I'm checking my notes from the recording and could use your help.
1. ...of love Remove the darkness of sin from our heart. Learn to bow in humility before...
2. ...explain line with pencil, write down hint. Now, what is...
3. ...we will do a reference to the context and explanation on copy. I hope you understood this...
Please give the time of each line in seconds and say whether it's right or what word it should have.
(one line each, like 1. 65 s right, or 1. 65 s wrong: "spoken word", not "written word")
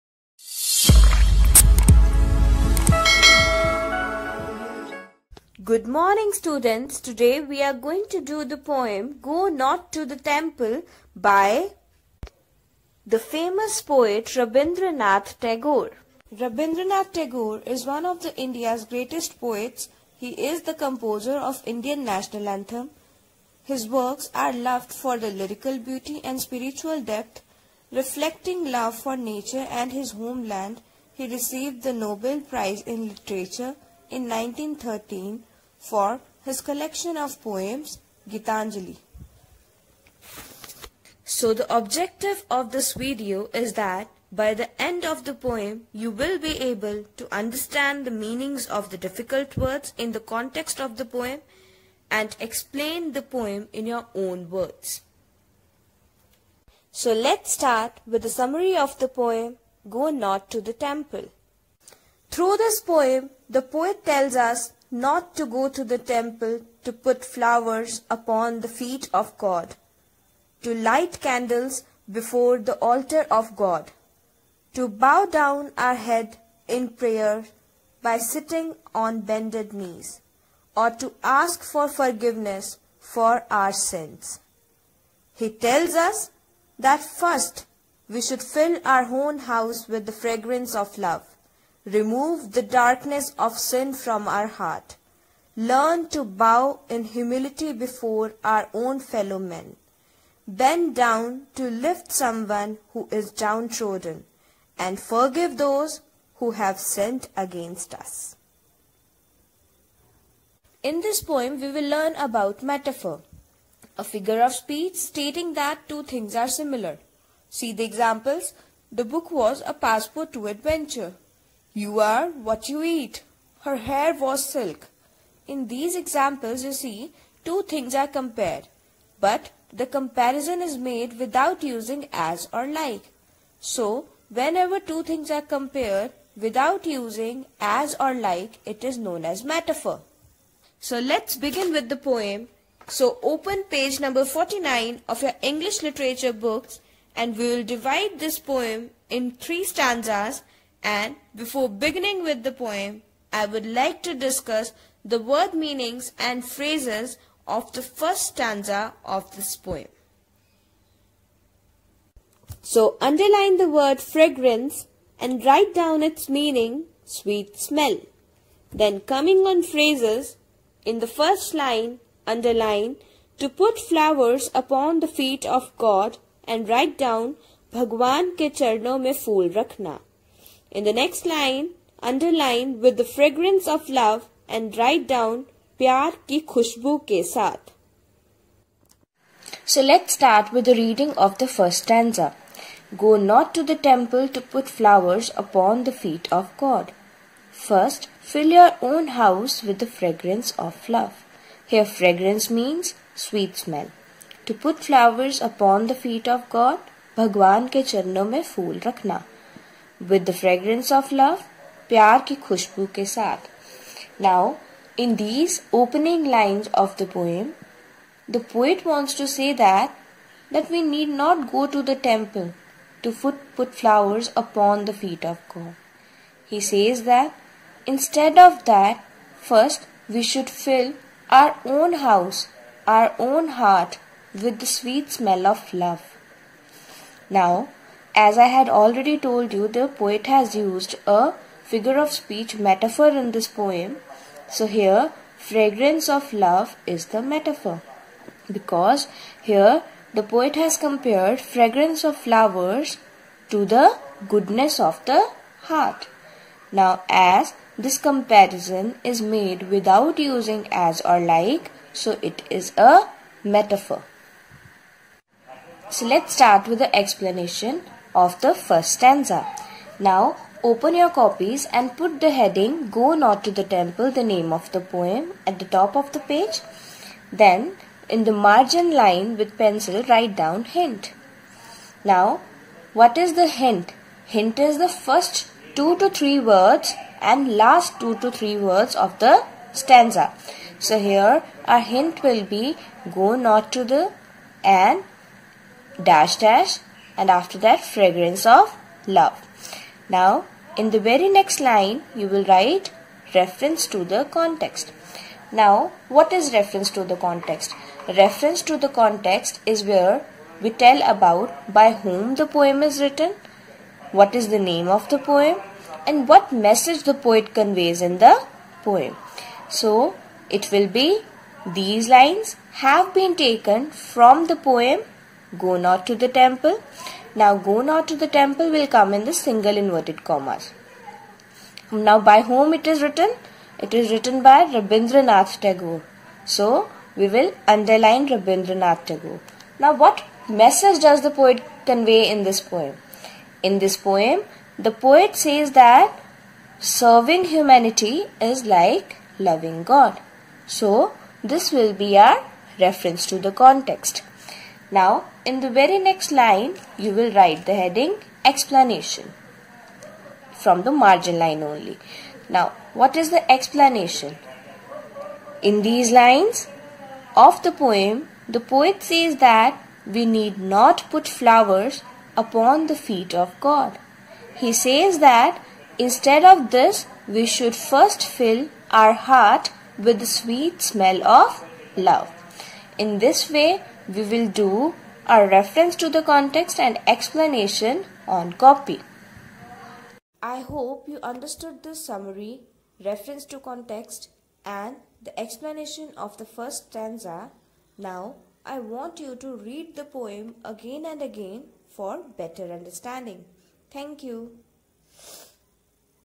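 1. 90 s right
2. 278 s wrong: "margin", not "explain"
3. 384 s right.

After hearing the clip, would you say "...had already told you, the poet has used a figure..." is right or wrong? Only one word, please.
right.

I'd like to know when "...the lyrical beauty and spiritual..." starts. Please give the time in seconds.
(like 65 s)
25 s.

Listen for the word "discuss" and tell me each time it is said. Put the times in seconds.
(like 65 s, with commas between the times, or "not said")
154 s.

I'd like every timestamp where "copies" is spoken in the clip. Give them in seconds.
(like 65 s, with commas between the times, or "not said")
271 s.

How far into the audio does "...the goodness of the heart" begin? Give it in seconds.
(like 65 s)
253 s.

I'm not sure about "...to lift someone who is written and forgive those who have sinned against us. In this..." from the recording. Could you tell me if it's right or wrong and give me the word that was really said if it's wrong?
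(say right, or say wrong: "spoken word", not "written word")
wrong: "downtrodden", not "written".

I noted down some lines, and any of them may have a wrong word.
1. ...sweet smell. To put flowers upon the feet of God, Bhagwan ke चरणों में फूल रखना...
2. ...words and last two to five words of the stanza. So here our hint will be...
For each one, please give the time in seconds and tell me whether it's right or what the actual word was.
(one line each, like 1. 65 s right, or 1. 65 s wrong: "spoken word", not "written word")
1. 203 s right
2. 286 s wrong: "three", not "five".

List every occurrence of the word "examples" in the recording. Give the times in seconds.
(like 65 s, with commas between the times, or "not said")
117 s, 125 s.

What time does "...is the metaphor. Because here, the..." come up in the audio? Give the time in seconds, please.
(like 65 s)
246 s.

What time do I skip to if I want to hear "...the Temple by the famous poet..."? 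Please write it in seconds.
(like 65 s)
10 s.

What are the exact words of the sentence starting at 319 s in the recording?
So it will be these lines have been taken from the poem go not to the temple.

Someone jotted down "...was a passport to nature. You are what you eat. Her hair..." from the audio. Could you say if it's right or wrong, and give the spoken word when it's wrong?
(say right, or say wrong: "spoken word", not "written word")
wrong: "adventure", not "nature".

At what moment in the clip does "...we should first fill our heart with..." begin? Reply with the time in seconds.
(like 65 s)
377 s.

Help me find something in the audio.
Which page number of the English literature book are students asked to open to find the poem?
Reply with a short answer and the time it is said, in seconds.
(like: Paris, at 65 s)
49, at 144 s.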